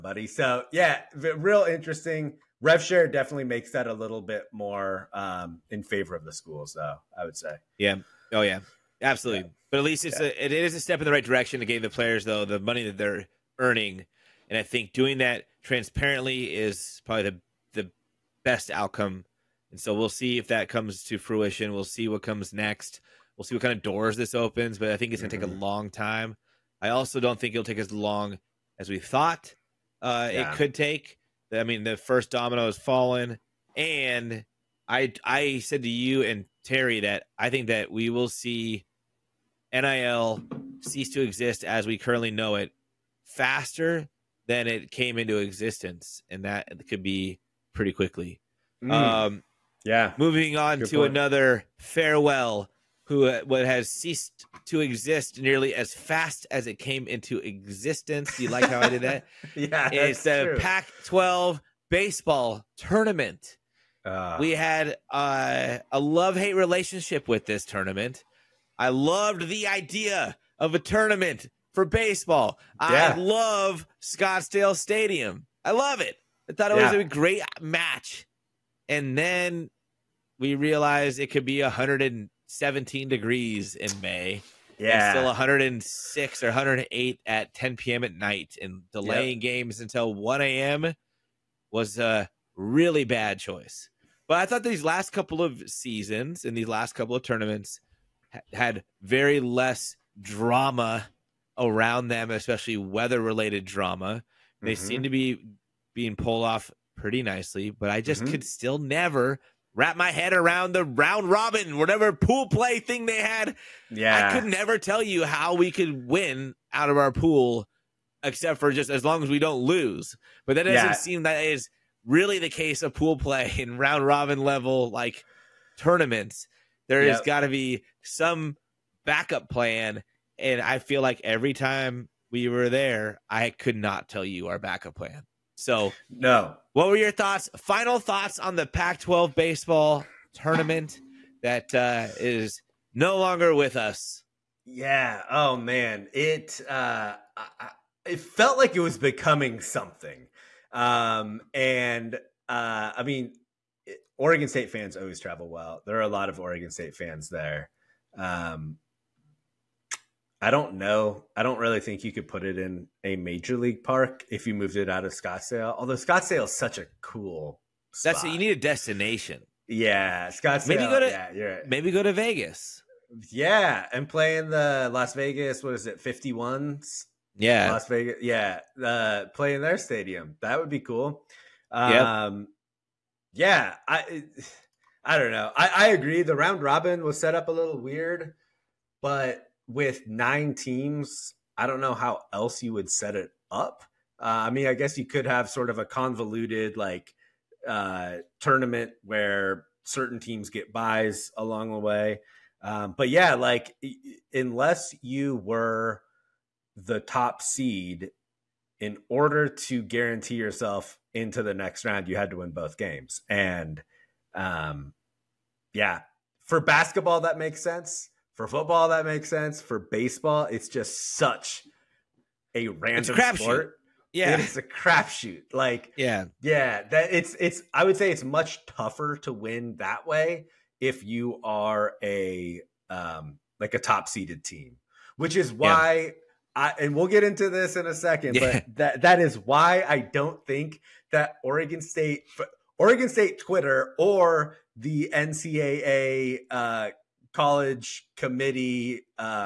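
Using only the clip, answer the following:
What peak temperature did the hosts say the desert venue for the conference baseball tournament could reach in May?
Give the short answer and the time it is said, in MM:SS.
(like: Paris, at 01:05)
117 degrees, at 01:21.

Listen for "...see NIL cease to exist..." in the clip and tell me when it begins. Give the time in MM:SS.
00:38.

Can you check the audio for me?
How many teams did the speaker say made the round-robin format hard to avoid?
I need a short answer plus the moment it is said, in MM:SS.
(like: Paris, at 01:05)
9, at 03:10.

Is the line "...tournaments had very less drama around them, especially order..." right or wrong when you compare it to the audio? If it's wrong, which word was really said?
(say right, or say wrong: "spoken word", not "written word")
wrong: "weather", not "order".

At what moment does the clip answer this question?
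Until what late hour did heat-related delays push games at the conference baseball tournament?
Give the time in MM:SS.
01:30.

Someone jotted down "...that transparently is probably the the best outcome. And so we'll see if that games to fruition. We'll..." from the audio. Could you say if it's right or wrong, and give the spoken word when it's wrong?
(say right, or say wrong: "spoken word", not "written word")
wrong: "comes", not "games".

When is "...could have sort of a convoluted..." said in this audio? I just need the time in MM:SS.
03:15.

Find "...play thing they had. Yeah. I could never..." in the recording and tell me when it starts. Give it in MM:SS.
01:52.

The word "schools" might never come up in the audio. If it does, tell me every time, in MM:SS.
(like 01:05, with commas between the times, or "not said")
00:06.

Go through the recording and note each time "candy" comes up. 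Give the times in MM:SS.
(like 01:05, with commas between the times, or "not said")
not said.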